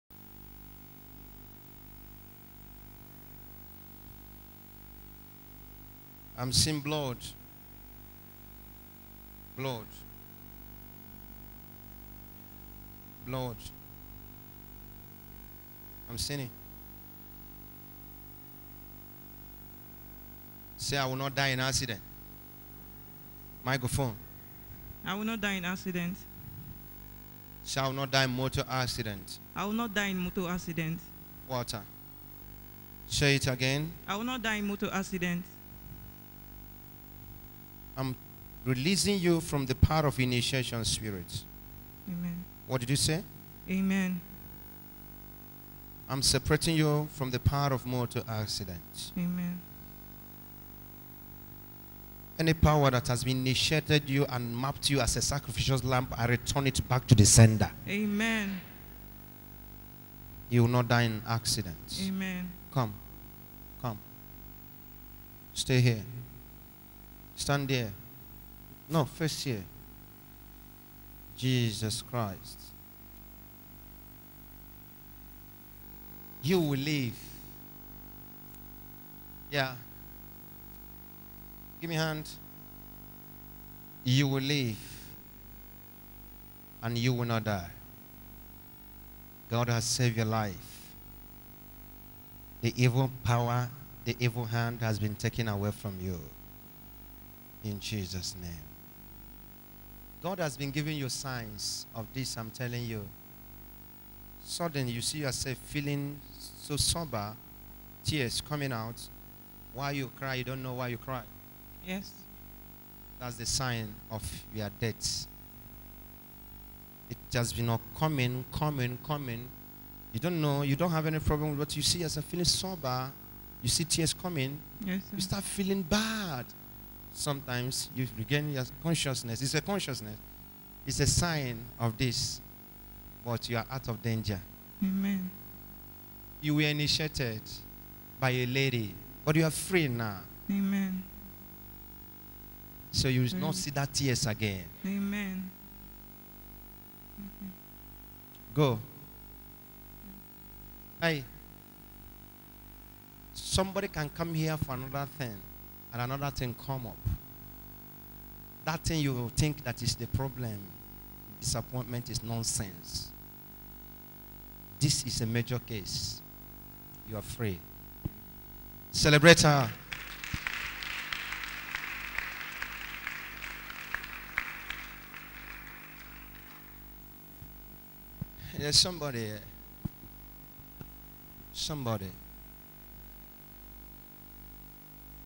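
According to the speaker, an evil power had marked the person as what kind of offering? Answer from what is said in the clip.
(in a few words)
sacrificial lamb.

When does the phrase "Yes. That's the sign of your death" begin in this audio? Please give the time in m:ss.
1:51.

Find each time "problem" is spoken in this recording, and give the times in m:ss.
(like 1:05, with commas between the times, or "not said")
2:01, 2:40.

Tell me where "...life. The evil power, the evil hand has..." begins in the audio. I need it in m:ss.
1:30.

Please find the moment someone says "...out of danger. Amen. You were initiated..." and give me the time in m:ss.
2:13.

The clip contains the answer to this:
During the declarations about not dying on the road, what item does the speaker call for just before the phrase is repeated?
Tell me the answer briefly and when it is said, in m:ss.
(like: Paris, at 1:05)
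Microphone, at 0:23.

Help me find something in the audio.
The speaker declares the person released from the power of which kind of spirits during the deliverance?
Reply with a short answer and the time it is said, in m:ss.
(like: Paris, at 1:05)
initiation spirits, at 0:40.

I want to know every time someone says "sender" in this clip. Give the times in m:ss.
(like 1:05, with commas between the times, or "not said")
0:57.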